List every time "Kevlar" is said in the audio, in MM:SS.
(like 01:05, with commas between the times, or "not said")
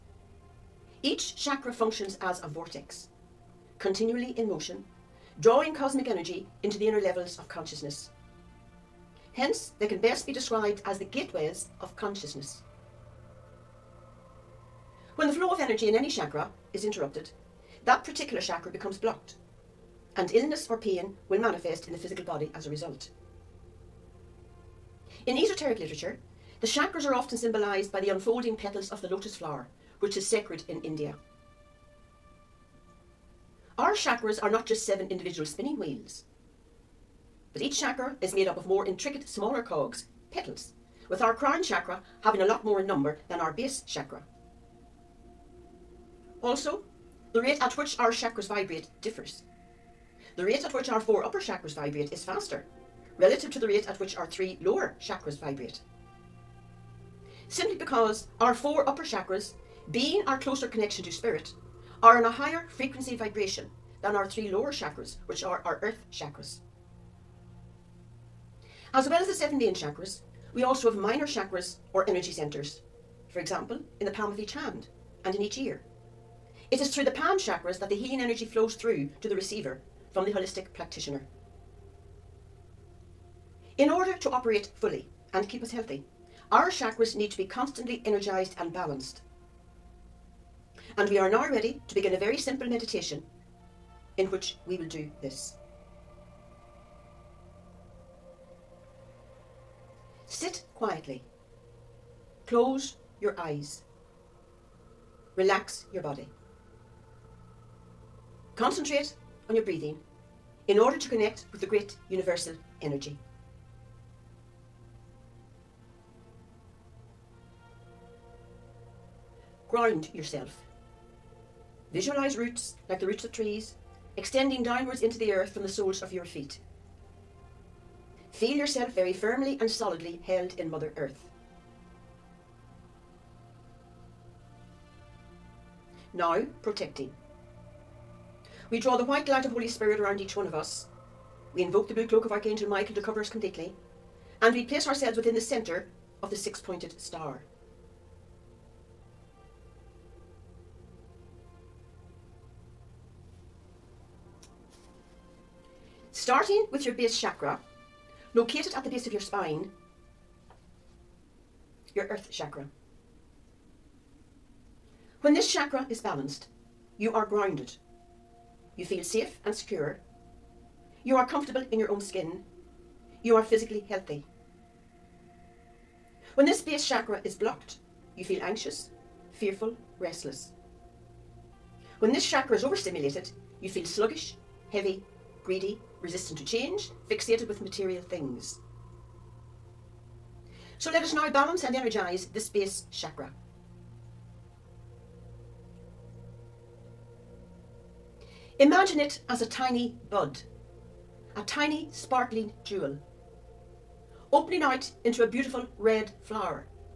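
not said.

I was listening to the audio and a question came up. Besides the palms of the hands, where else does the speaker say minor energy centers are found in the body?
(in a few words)
In each ear.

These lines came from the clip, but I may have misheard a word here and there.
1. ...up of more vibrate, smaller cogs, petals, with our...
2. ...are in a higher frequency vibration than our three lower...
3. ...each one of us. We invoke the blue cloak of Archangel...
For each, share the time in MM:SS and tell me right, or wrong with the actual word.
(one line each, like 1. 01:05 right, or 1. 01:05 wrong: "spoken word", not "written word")
1. 00:38 wrong: "intricate", not "vibrate"
2. 01:02 right
3. 02:20 right.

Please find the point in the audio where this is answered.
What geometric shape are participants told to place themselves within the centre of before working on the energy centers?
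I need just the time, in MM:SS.
02:26.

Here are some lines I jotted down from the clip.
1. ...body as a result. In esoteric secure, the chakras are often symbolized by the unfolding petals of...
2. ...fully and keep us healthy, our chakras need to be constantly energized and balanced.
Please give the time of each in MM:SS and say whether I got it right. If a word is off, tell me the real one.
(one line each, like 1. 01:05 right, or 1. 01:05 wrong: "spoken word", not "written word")
1. 00:22 wrong: "literature", not "secure"
2. 01:24 right.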